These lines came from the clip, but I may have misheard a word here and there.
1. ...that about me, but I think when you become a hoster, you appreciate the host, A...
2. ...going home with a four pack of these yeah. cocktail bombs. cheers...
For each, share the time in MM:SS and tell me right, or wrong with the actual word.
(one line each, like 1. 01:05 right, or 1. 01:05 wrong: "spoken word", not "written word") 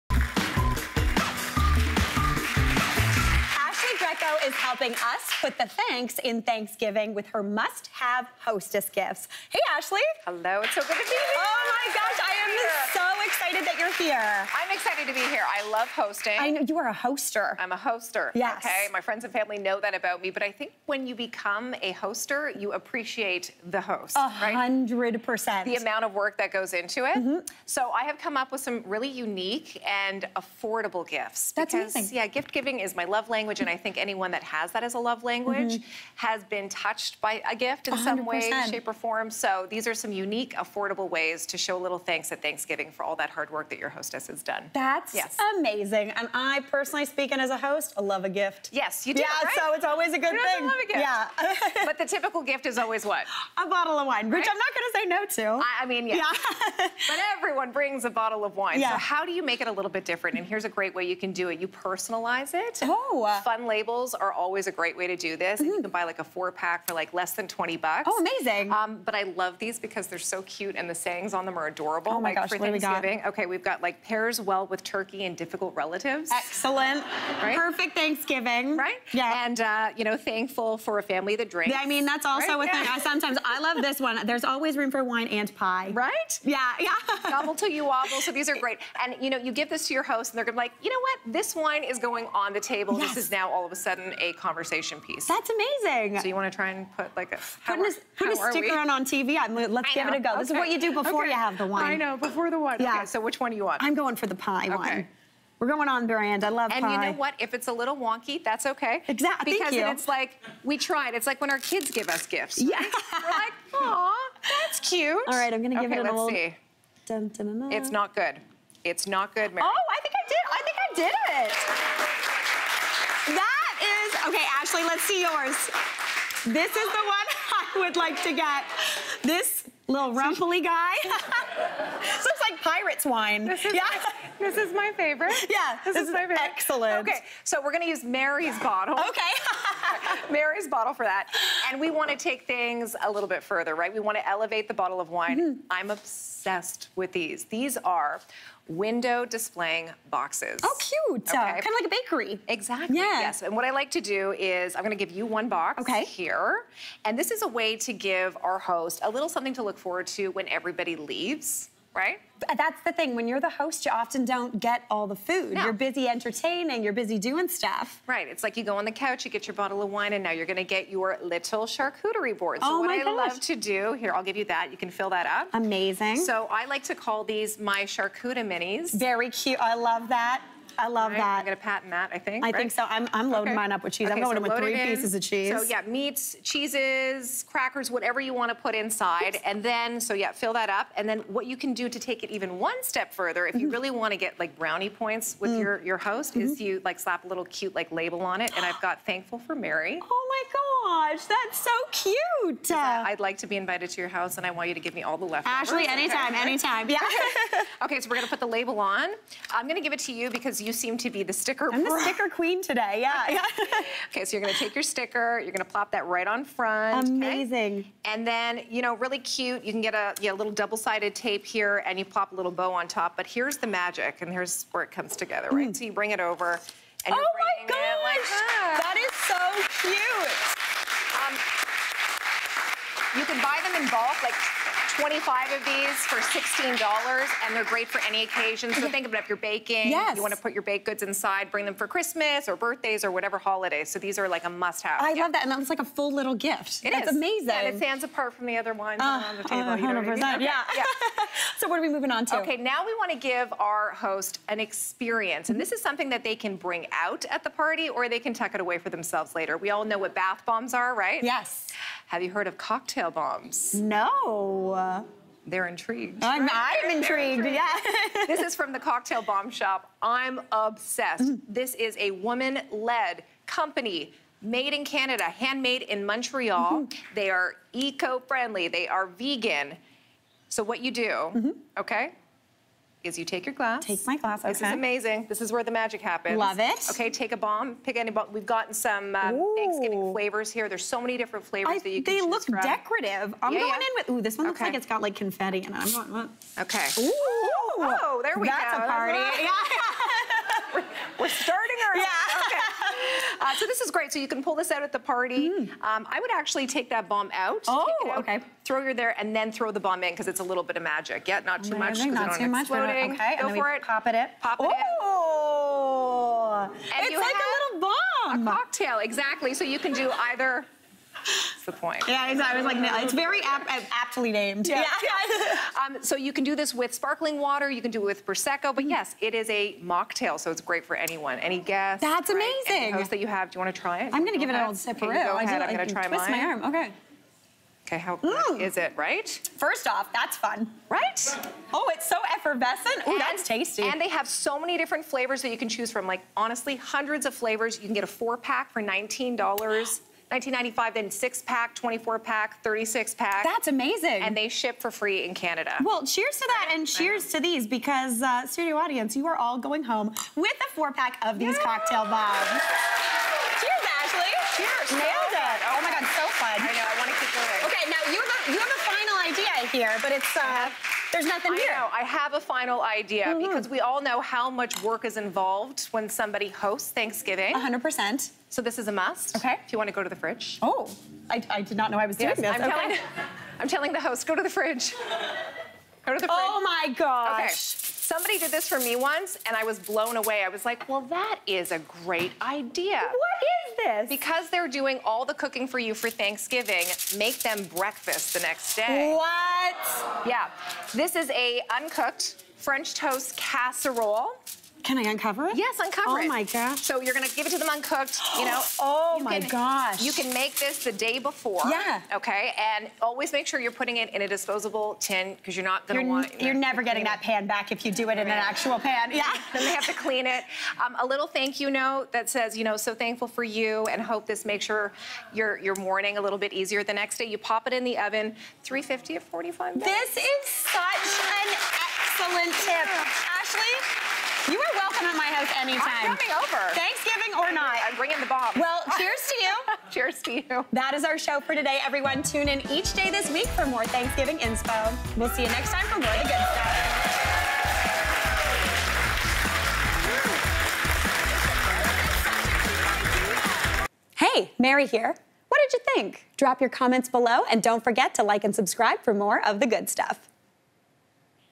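1. 00:19 right
2. 05:59 right.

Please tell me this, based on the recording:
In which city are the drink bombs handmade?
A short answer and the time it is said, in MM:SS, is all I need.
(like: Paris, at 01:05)
Montreal, at 04:36.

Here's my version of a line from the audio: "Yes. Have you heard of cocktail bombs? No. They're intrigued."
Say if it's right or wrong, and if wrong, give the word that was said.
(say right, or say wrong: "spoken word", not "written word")
right.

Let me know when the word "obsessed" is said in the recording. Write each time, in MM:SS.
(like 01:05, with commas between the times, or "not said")
02:25, 04:30.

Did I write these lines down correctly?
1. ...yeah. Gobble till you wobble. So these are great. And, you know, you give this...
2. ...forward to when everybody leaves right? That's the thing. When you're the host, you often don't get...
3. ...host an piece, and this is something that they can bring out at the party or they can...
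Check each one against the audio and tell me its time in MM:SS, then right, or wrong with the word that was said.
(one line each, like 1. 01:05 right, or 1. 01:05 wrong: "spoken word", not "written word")
1. 01:26 right
2. 02:39 right
3. 04:13 wrong: "experience", not "piece".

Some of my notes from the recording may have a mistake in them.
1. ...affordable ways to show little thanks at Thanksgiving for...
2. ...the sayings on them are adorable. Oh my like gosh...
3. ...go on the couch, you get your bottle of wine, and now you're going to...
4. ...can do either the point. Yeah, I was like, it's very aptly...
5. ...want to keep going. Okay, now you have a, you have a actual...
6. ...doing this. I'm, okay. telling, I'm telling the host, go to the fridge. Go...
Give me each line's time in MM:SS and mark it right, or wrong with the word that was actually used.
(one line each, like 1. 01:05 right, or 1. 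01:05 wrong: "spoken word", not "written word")
1. 00:40 right
2. 01:10 right
3. 02:48 right
4. 05:19 right
5. 06:06 wrong: "final", not "actual"
6. 06:22 right.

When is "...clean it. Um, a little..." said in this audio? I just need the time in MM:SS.
06:59.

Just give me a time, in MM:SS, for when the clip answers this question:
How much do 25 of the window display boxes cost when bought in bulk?
03:56.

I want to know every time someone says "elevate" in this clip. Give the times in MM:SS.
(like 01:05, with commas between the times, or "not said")
02:24.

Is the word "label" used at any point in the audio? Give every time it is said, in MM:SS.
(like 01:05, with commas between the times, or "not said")
01:03, 03:17, 03:28.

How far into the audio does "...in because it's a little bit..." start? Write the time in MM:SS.
05:10.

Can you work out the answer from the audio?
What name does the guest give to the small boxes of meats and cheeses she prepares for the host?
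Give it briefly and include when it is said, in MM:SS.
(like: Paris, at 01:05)
charcuterie minis, at 02:57.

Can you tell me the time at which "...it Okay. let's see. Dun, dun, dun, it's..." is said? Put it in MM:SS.
01:55.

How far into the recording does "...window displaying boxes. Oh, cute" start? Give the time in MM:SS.
02:28.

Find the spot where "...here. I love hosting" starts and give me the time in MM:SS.
00:15.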